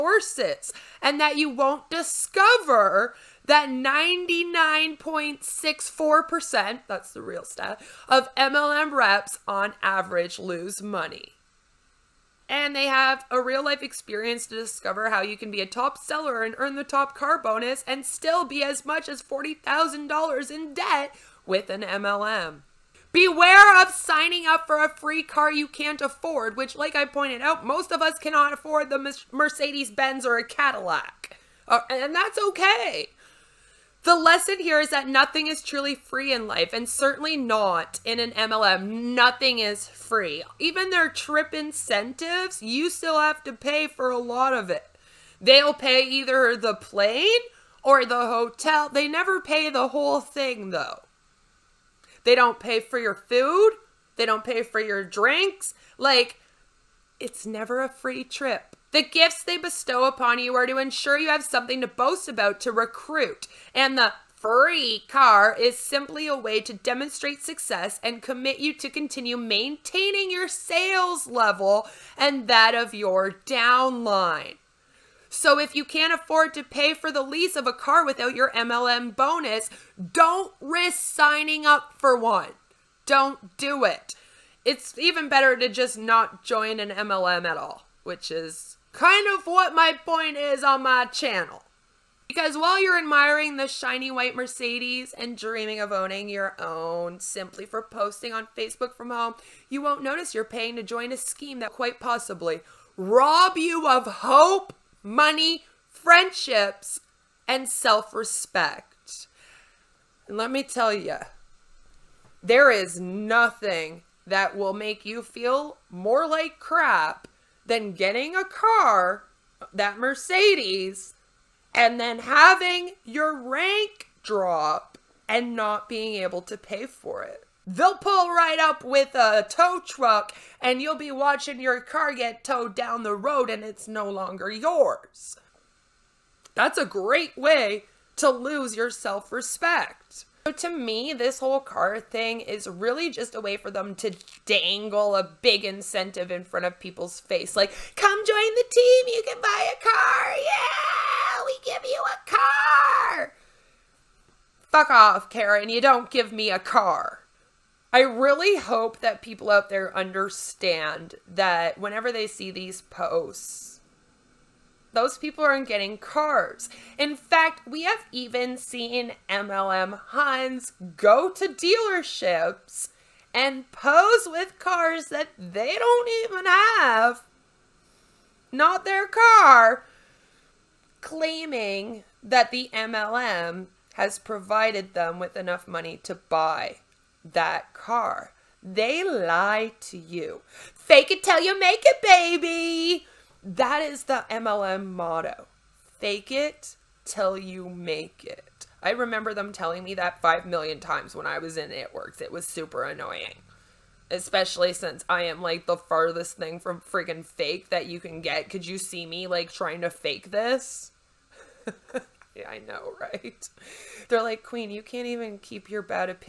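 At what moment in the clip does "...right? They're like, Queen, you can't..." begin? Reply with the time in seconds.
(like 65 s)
212 s.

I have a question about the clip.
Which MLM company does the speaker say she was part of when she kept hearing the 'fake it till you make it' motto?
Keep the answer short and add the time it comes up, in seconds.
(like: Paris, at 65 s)
It Works, at 201 s.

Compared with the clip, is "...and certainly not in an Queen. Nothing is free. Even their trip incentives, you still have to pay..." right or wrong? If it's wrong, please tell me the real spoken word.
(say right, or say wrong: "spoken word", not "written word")
wrong: "MLM", not "Queen".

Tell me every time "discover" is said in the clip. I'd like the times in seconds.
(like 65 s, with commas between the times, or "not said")
1 s, 14 s.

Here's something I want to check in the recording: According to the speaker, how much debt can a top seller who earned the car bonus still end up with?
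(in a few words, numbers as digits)
$40,000.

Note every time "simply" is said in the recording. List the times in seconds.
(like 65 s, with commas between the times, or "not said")
65 s, 97 s.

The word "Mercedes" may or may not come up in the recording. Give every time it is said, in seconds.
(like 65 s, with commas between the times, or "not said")
29 s, 94 s, 119 s.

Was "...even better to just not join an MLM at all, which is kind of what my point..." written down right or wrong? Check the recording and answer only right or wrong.
right.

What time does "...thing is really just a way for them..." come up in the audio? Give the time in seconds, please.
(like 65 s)
141 s.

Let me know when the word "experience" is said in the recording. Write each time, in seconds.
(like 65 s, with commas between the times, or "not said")
13 s.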